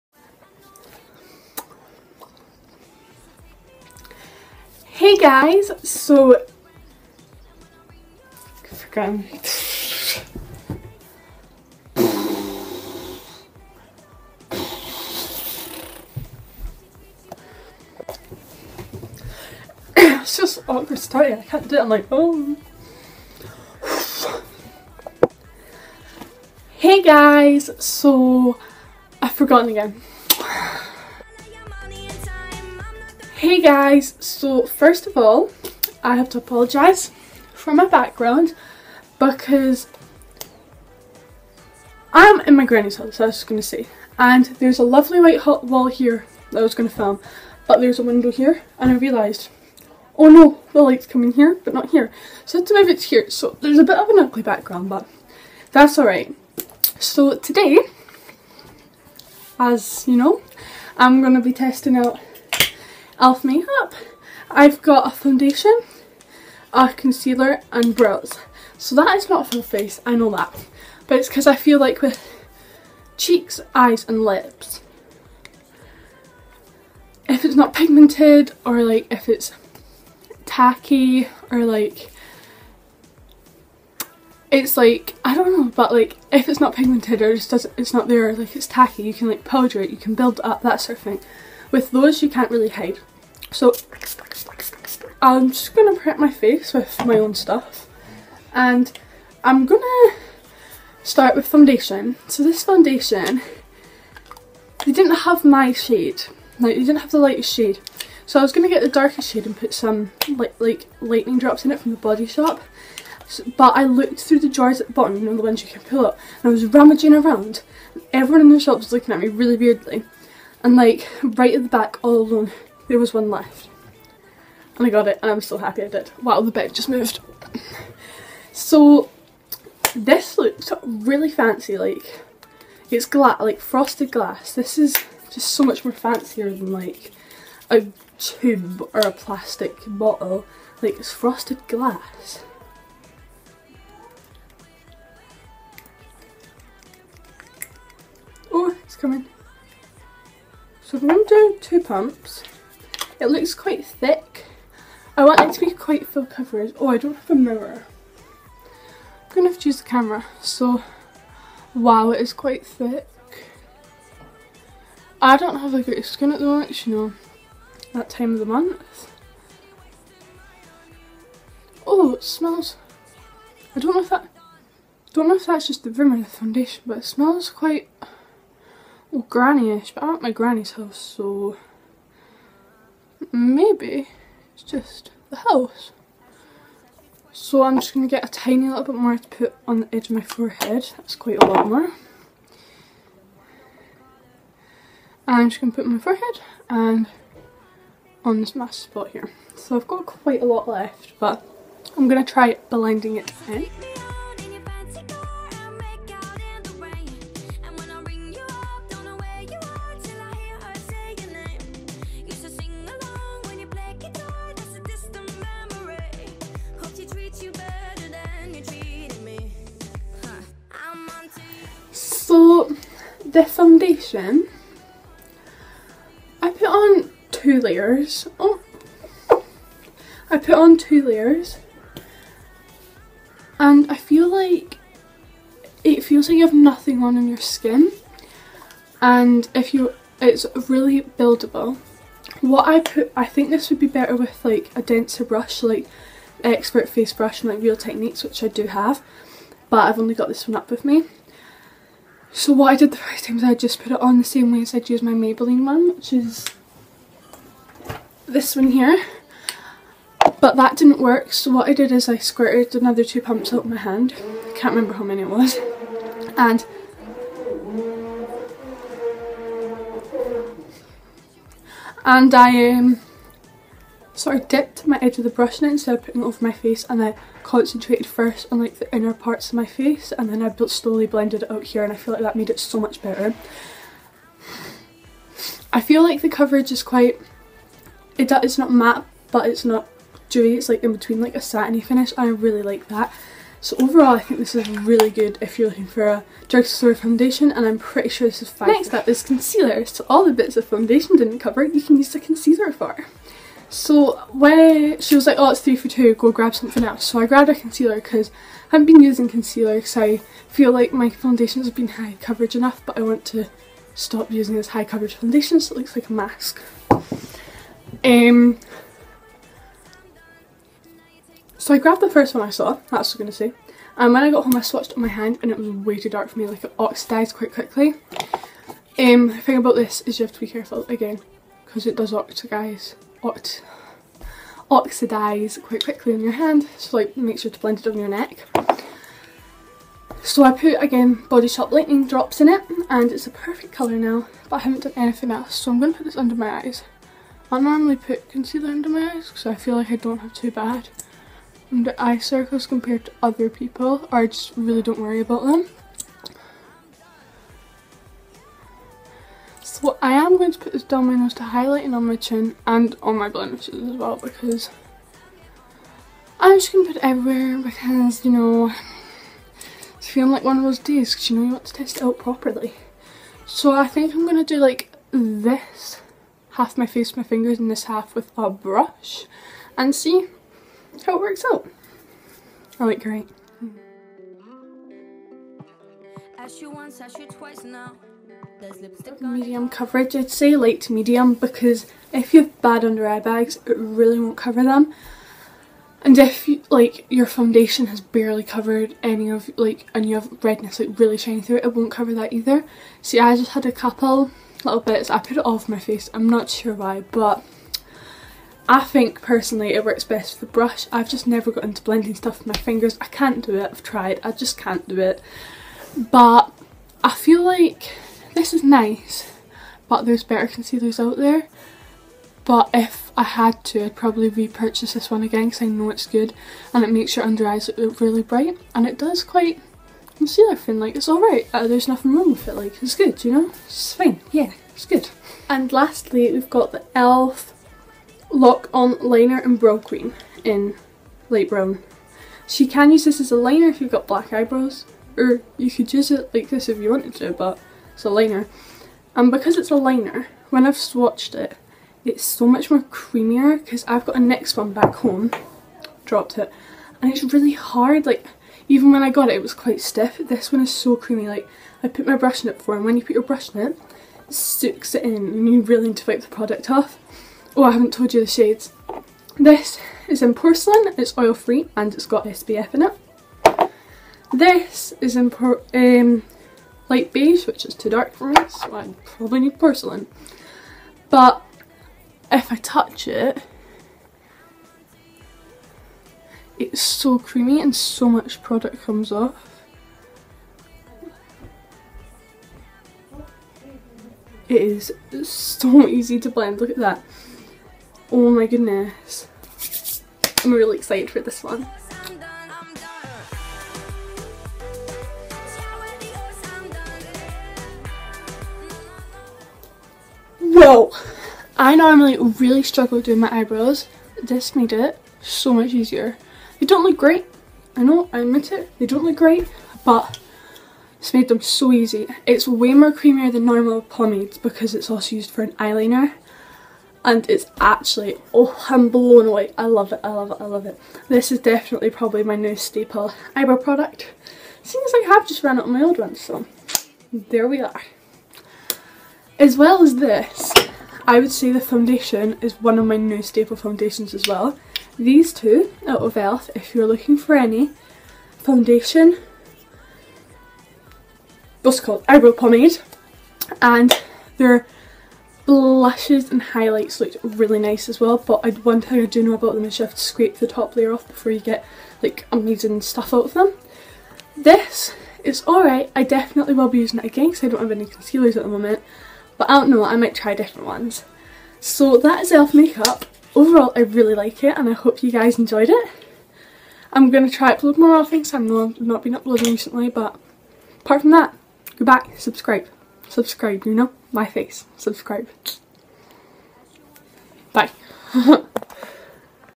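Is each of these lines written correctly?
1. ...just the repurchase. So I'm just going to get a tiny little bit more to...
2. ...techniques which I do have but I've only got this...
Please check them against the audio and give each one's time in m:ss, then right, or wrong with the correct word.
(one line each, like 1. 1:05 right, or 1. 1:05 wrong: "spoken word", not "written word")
1. 3:04 wrong: "house", not "repurchase"
2. 4:07 right.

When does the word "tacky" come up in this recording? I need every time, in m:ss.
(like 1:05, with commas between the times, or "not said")
1:20, 1:28.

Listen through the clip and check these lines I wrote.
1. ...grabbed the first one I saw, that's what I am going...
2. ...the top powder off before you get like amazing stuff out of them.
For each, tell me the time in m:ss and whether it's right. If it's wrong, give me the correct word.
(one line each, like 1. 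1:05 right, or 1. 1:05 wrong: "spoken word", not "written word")
1. 5:21 right
2. 9:20 wrong: "layer", not "powder".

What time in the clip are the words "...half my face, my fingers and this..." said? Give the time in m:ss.
6:16.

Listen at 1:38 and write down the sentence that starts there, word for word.
And I'm going to start with foundation.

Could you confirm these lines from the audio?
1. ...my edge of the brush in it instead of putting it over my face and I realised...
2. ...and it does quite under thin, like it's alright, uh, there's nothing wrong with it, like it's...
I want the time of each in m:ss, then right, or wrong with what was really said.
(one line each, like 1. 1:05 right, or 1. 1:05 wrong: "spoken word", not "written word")
1. 4:34 wrong: "concentrated", not "realised"
2. 7:08 wrong: "concealer", not "under".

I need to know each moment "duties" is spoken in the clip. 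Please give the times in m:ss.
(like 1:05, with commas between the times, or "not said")
not said.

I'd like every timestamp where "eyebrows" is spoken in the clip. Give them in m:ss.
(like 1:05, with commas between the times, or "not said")
7:24, 8:33, 8:53, 9:12.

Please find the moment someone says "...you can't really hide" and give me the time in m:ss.
1:32.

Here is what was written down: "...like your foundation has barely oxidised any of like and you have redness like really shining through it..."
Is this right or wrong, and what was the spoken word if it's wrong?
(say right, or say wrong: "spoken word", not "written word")
wrong: "covered", not "oxidised".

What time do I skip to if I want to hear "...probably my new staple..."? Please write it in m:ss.
8:51.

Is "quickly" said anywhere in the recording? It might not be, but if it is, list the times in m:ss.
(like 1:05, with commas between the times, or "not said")
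5:27, 5:35.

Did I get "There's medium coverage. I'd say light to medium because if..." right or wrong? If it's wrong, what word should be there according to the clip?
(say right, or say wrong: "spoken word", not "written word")
right.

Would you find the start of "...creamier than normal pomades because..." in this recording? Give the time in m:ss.
8:42.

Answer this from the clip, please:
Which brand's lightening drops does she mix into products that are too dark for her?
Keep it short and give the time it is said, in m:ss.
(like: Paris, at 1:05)
The Body Shop, at 1:51.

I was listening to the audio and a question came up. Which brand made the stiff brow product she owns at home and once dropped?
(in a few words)
NYX.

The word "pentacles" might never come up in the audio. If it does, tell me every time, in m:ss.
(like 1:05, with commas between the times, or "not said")
not said.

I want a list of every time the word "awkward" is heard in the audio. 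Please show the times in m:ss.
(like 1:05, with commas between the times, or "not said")
0:20.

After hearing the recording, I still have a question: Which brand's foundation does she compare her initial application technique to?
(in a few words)
Maybelline.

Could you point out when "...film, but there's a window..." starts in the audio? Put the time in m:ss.
0:46.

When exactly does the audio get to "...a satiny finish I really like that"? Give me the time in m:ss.
4:51.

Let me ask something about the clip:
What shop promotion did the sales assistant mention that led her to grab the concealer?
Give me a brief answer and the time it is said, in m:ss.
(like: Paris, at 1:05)
Three for two, at 5:05.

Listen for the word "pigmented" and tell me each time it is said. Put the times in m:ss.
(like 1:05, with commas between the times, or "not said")
1:17, 1:26.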